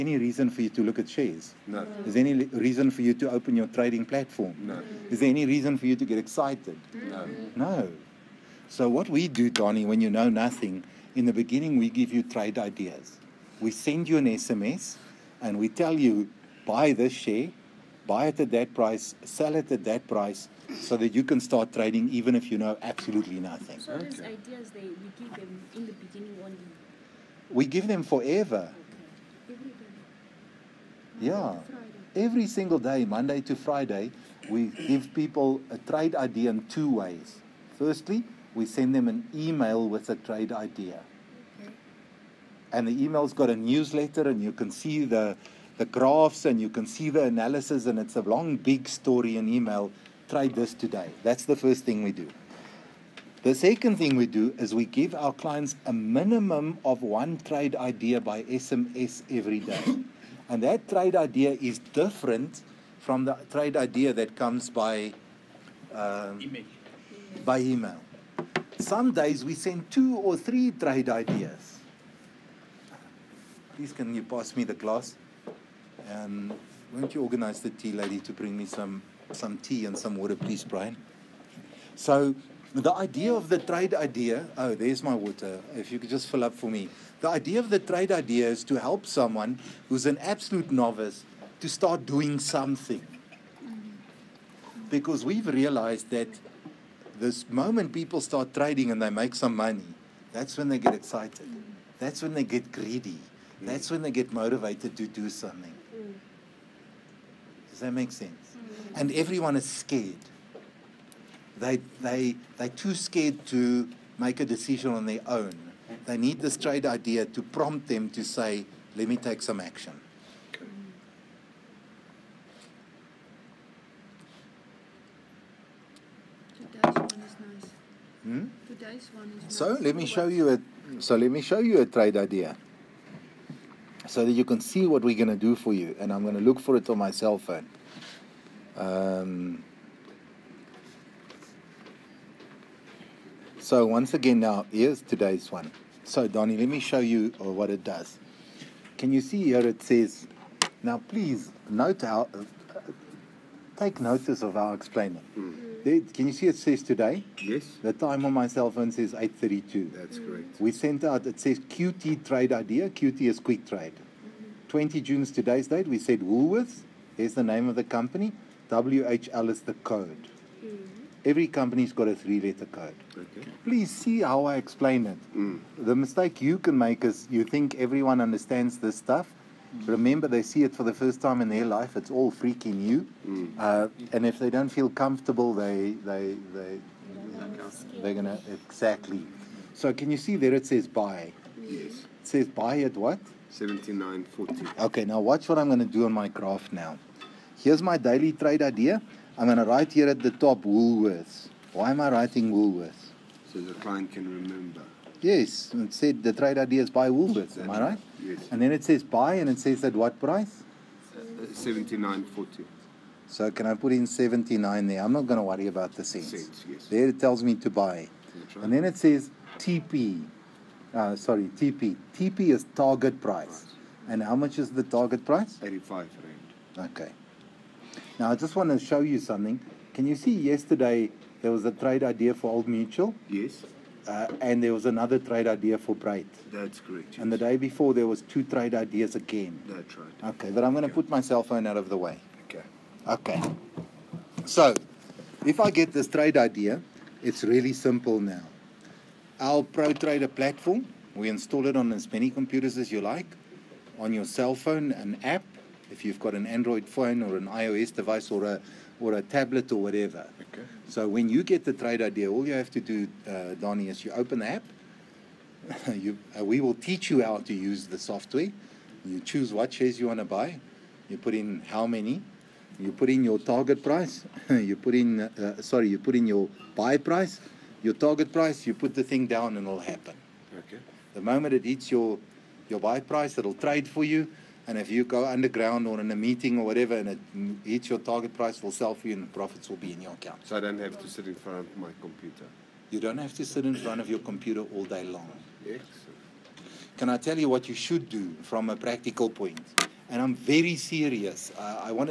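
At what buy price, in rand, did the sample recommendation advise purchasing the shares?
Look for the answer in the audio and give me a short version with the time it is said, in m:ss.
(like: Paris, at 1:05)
79.40, at 3:13.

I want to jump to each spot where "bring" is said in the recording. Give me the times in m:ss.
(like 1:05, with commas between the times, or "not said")
1:18.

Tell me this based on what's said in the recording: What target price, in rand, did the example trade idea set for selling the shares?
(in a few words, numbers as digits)
85 rand.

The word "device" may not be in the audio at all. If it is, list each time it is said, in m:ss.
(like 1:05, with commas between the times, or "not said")
4:17.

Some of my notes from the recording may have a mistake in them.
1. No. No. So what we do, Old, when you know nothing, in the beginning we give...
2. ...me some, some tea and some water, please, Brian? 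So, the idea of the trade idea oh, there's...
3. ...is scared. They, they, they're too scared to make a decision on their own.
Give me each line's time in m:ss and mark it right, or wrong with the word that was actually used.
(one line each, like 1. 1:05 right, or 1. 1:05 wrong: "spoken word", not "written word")
1. 0:07 wrong: "Donnie", not "Old"
2. 1:18 right
3. 1:49 right.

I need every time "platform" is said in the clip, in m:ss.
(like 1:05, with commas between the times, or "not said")
0:04, 4:10.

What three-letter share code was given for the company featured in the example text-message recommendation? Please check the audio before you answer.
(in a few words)
WHL.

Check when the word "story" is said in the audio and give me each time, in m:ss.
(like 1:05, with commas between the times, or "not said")
0:48.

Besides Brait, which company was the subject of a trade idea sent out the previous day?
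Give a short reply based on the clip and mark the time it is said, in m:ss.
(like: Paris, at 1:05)
Old Mutual, at 3:52.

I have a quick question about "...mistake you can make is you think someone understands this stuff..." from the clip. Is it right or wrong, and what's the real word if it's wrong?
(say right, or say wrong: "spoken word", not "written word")
wrong: "everyone", not "someone".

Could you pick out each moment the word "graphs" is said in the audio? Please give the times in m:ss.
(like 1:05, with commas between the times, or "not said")
0:45, 3:16.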